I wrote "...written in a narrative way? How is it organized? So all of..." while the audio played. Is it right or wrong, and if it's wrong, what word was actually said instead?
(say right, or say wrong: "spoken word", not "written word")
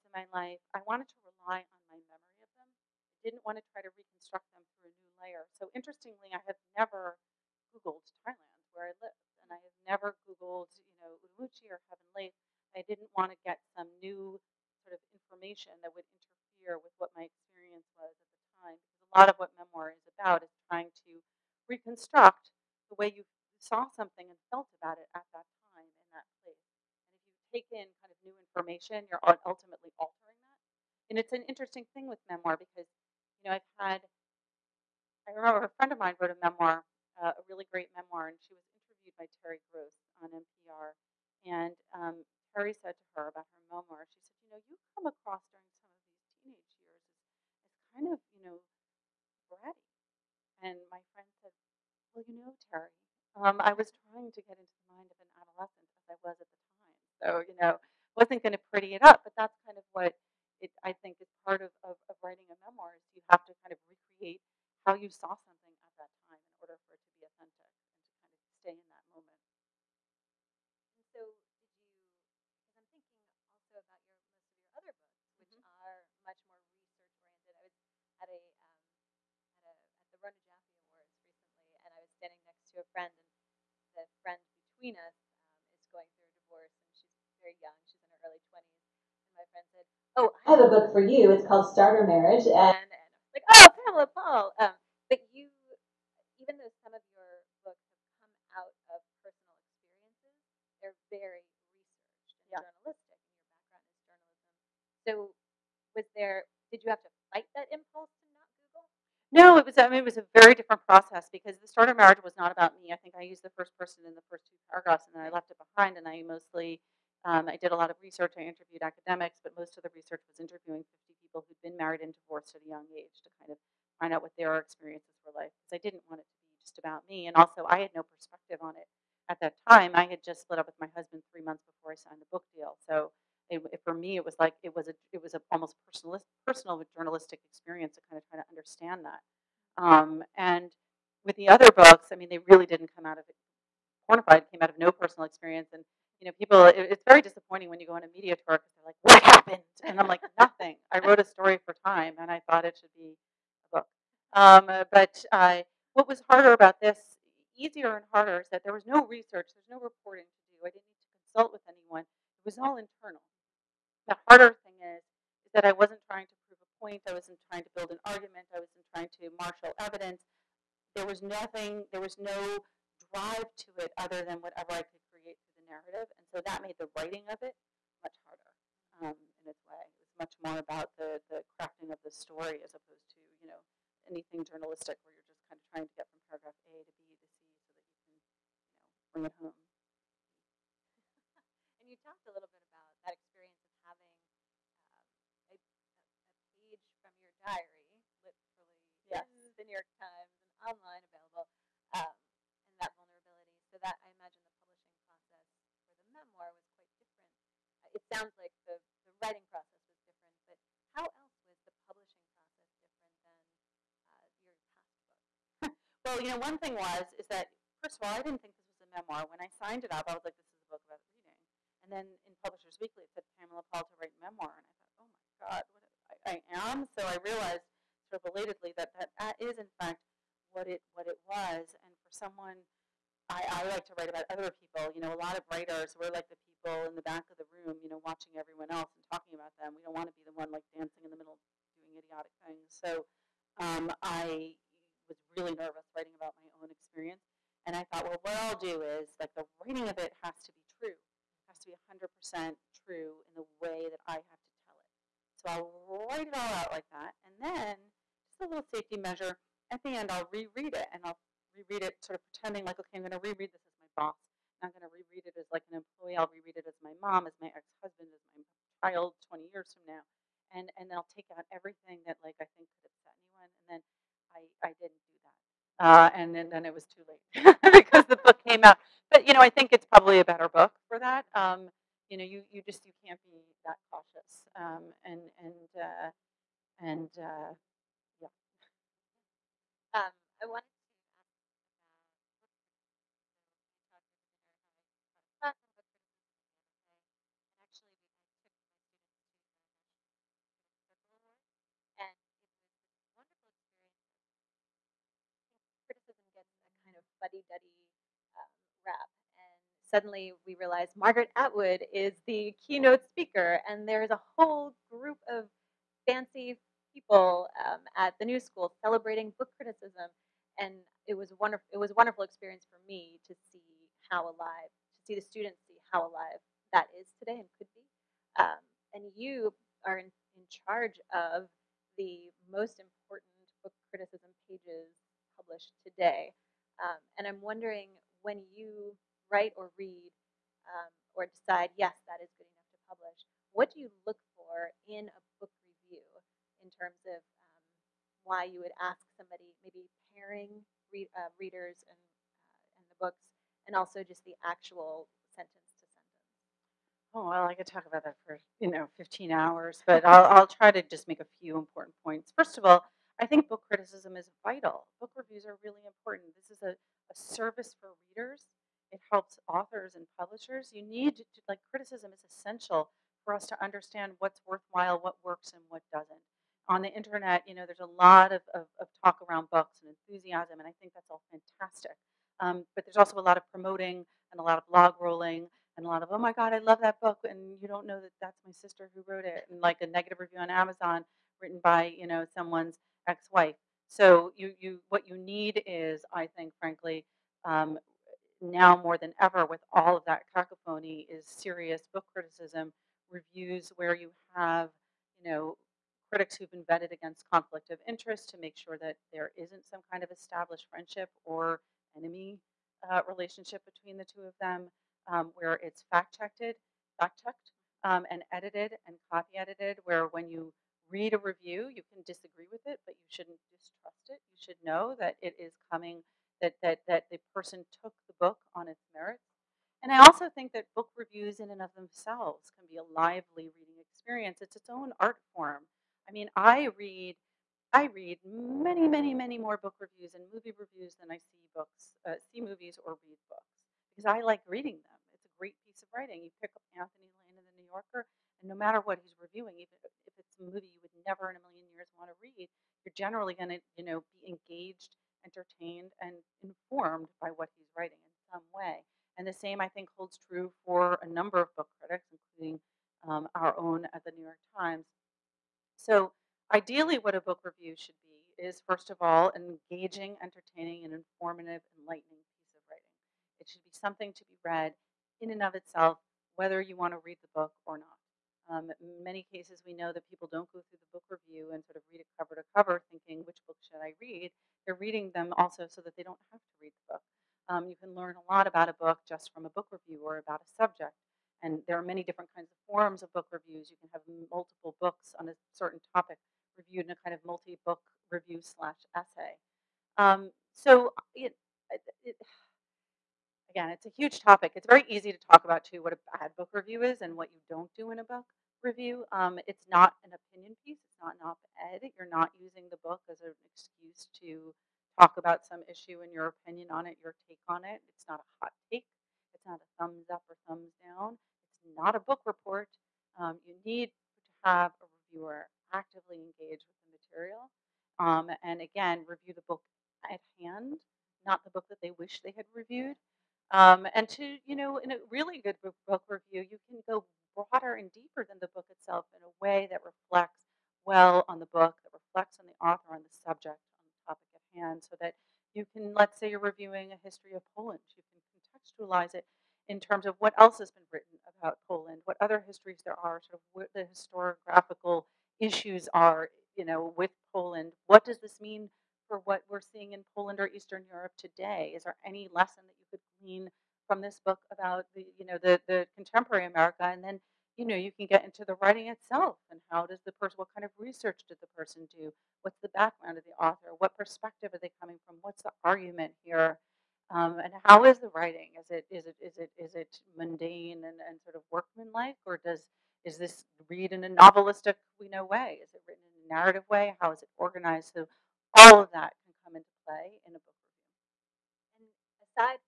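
right.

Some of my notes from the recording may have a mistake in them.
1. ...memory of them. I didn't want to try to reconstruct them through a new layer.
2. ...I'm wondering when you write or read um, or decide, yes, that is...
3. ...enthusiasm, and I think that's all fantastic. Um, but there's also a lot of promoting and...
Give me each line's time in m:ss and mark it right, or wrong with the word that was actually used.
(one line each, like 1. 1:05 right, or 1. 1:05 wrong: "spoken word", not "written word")
1. 0:02 right
2. 5:37 right
3. 6:20 right.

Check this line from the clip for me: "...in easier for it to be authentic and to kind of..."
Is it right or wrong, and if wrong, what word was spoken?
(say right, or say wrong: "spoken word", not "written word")
wrong: "order", not "easier".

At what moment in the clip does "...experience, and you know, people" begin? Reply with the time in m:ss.
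2:25.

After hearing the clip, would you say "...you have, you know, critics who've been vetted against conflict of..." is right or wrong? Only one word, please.
right.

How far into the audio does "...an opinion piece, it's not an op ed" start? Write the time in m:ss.
8:30.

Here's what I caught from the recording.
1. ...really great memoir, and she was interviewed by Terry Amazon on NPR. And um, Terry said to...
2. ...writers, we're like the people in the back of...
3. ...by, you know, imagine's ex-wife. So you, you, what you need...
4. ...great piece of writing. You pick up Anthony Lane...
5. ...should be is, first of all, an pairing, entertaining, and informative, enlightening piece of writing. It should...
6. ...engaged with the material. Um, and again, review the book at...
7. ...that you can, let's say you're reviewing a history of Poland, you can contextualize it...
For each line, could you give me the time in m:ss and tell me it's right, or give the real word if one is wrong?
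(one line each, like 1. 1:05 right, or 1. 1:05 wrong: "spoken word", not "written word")
1. 0:37 wrong: "Gross", not "Amazon"
2. 3:55 right
3. 6:31 wrong: "someone", not "imagine"
4. 7:25 right
5. 7:47 wrong: "engaging", not "pairing"
6. 8:46 right
7. 9:04 right.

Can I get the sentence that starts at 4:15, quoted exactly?
So I'll write it all out like that.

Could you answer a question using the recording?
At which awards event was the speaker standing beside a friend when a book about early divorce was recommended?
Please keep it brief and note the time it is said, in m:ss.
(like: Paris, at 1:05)
Rona Jaffe Awards, at 1:20.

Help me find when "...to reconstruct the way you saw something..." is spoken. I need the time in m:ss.
0:21.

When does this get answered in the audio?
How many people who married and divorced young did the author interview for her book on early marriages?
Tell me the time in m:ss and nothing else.
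2:01.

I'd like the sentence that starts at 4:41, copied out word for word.
Um, you know, you, you just you can't be that cautious.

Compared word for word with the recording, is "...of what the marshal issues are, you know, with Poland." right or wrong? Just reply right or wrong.
wrong.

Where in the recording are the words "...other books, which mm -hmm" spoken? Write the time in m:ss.
1:14.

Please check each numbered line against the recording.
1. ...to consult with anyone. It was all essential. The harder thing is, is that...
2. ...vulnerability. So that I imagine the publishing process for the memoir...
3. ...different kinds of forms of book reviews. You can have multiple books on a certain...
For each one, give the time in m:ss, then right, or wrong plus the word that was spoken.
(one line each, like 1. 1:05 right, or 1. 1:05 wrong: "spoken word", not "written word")
1. 2:41 wrong: "internal", not "essential"
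2. 3:22 right
3. 8:12 right.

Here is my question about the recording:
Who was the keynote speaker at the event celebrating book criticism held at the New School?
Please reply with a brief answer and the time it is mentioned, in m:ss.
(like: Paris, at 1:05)
Margaret Atwood, at 5:10.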